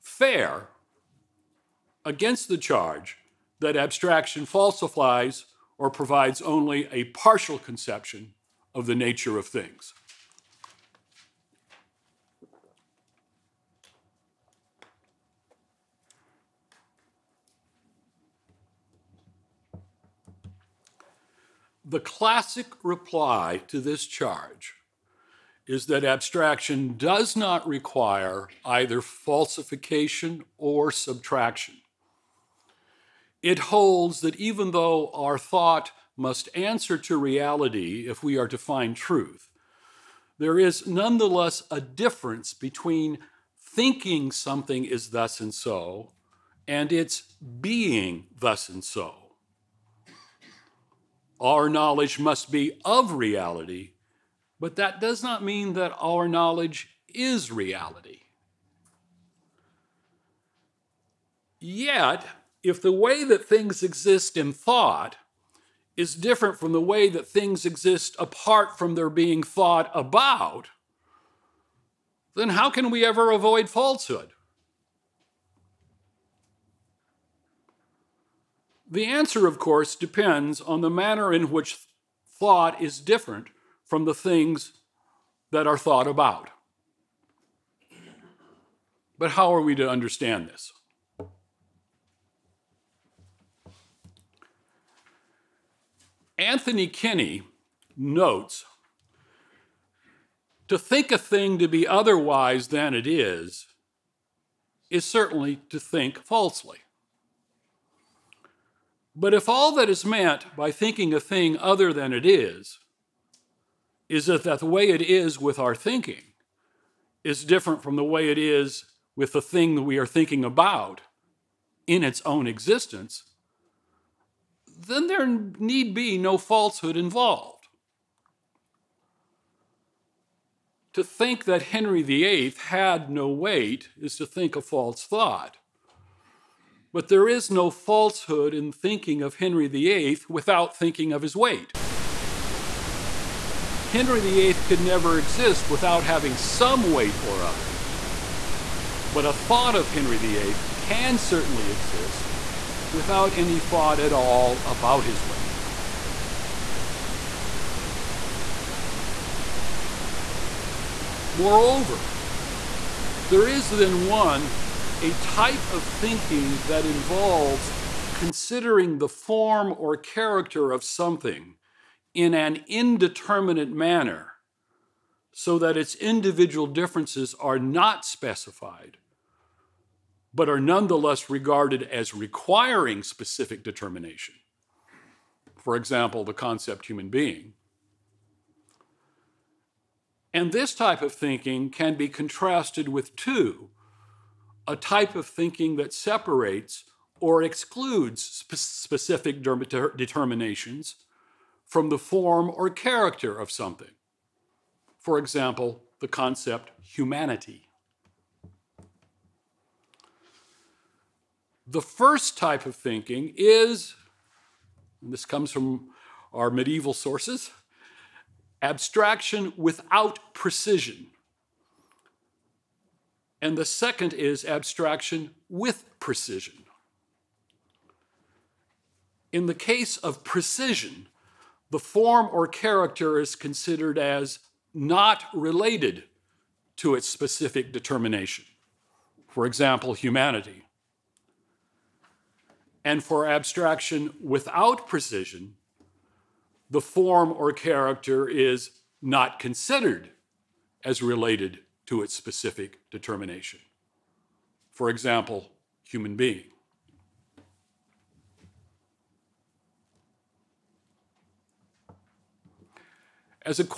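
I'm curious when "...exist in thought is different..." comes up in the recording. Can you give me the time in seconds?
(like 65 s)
63 s.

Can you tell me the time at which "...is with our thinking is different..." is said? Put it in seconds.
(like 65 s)
115 s.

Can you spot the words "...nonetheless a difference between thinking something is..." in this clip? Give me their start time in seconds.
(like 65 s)
40 s.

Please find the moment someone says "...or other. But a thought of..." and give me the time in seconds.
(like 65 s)
147 s.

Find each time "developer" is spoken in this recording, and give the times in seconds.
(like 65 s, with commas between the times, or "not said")
not said.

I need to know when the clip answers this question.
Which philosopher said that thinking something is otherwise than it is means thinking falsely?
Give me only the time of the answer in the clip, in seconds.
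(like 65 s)
96 s.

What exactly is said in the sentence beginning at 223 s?
And the second is abstraction with precision.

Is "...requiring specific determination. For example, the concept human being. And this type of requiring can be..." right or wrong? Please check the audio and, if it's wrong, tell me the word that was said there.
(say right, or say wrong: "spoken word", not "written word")
wrong: "thinking", not "requiring".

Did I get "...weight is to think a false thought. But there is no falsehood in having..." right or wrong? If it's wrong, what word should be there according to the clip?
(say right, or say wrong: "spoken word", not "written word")
wrong: "thinking", not "having".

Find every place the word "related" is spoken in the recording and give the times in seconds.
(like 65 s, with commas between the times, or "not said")
235 s, 251 s.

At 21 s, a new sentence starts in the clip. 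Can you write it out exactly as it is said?
The classic reply to this charge is that abstraction does not require either falsification or subtraction.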